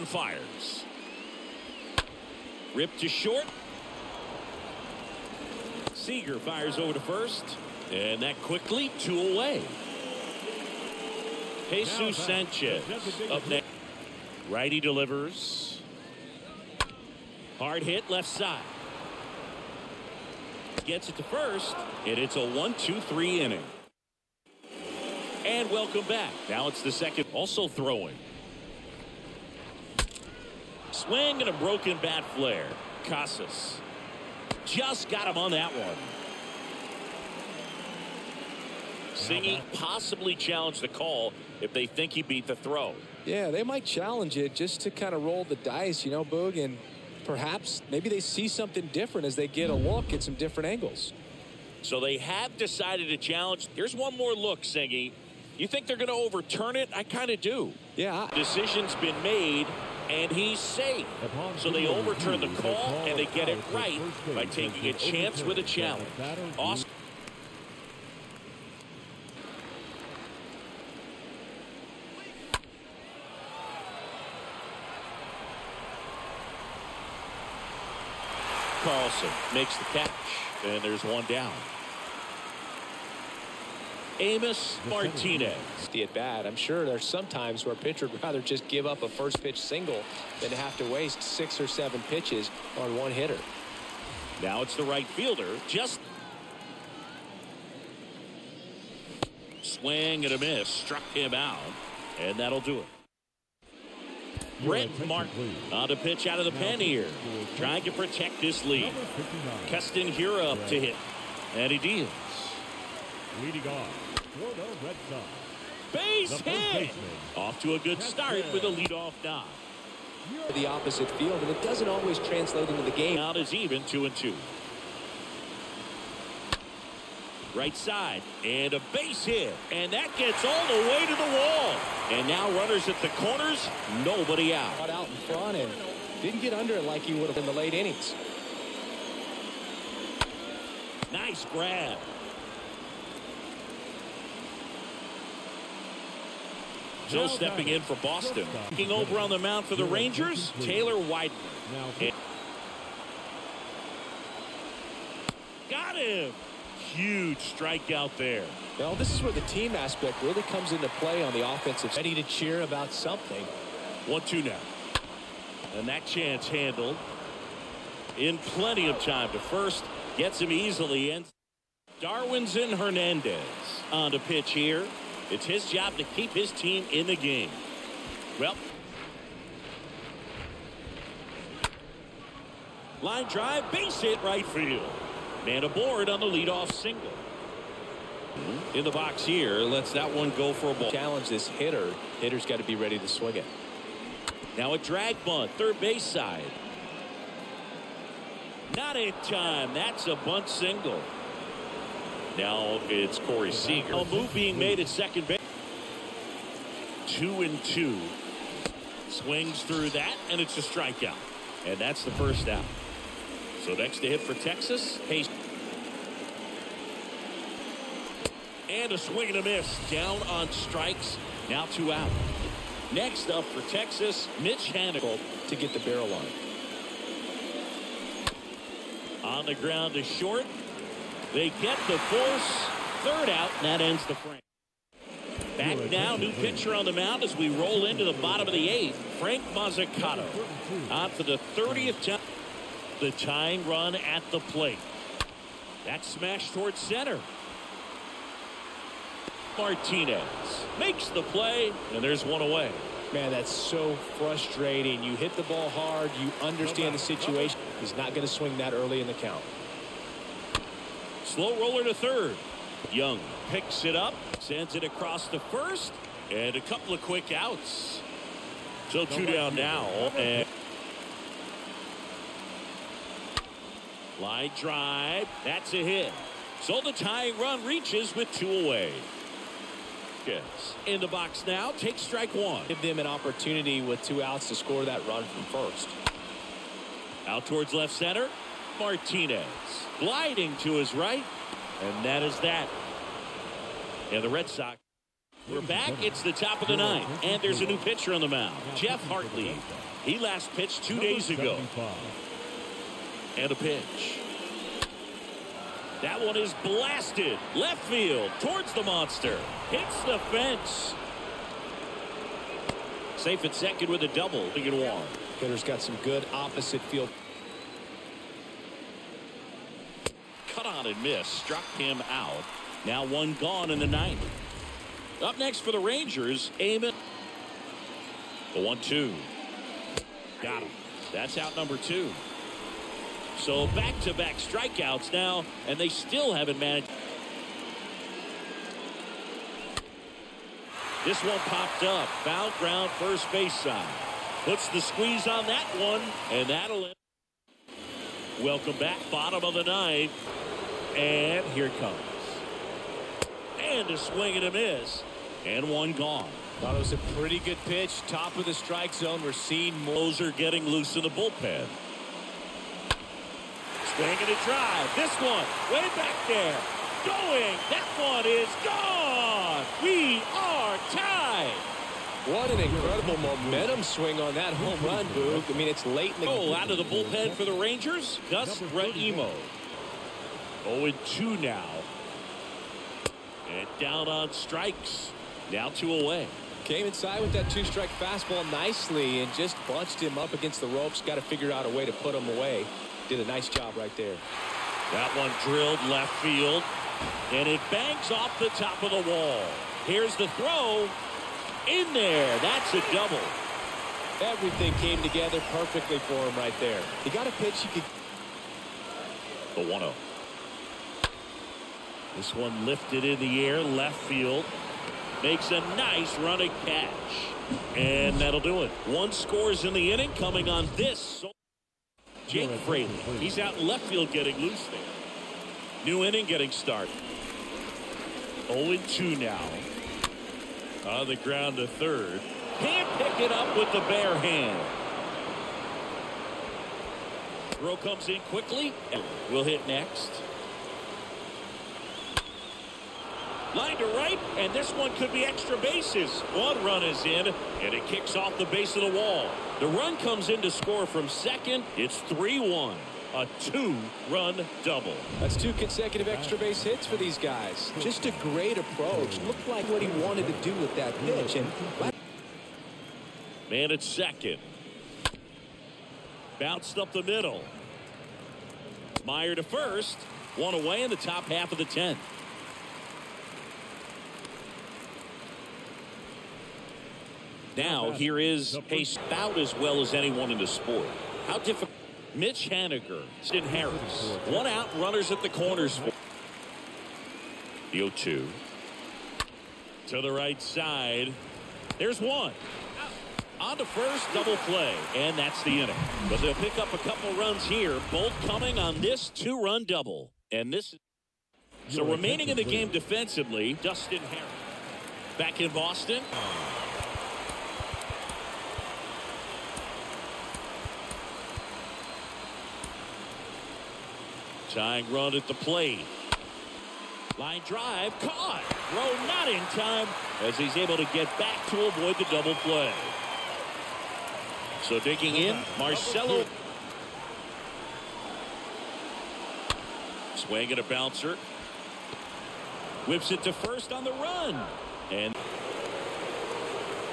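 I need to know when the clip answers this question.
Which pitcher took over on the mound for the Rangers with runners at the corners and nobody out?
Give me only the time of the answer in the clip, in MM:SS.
02:30.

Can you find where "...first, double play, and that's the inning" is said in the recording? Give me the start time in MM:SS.
08:13.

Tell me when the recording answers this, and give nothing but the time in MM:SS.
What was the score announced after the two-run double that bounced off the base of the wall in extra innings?
07:32.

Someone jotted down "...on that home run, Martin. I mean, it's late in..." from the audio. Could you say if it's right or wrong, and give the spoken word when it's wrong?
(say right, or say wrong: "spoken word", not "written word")
wrong: "Boog", not "Martin".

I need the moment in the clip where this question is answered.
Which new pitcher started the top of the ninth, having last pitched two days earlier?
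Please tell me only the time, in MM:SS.
04:58.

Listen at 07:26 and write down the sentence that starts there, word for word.
One run is in, and it kicks off the base of the wall.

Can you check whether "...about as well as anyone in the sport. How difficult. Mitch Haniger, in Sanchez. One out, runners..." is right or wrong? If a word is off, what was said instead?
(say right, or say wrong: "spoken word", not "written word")
wrong: "Harris", not "Sanchez".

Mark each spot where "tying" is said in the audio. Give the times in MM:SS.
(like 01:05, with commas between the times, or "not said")
04:03, 04:36, 08:34.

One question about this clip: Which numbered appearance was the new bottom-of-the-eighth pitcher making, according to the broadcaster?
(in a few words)
30th.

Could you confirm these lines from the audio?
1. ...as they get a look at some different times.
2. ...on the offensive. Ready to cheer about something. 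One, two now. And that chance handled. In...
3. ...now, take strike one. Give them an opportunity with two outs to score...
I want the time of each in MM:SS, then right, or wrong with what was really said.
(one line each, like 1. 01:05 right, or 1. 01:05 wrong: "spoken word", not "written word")
1. 00:49 wrong: "angles", not "times"
2. 02:41 right
3. 04:41 right.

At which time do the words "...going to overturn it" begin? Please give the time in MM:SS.
00:55.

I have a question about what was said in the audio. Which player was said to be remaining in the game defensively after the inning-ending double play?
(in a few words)
Dustin Harris.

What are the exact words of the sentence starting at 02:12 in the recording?
And now runners at the corners, nobody out.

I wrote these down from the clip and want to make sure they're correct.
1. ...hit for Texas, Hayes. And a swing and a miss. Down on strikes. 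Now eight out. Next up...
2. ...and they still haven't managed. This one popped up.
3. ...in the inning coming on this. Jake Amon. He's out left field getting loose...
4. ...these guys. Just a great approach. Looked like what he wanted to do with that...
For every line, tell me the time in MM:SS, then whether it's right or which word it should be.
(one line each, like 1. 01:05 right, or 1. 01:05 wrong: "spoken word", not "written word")
1. 03:34 wrong: "two", not "eight"
2. 05:35 right
3. 06:59 wrong: "Fraley", not "Amon"
4. 07:36 right.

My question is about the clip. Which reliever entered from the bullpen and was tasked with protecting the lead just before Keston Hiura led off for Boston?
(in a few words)
Brent Martin.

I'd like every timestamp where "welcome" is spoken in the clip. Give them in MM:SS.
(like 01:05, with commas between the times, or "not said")
00:25, 05:48.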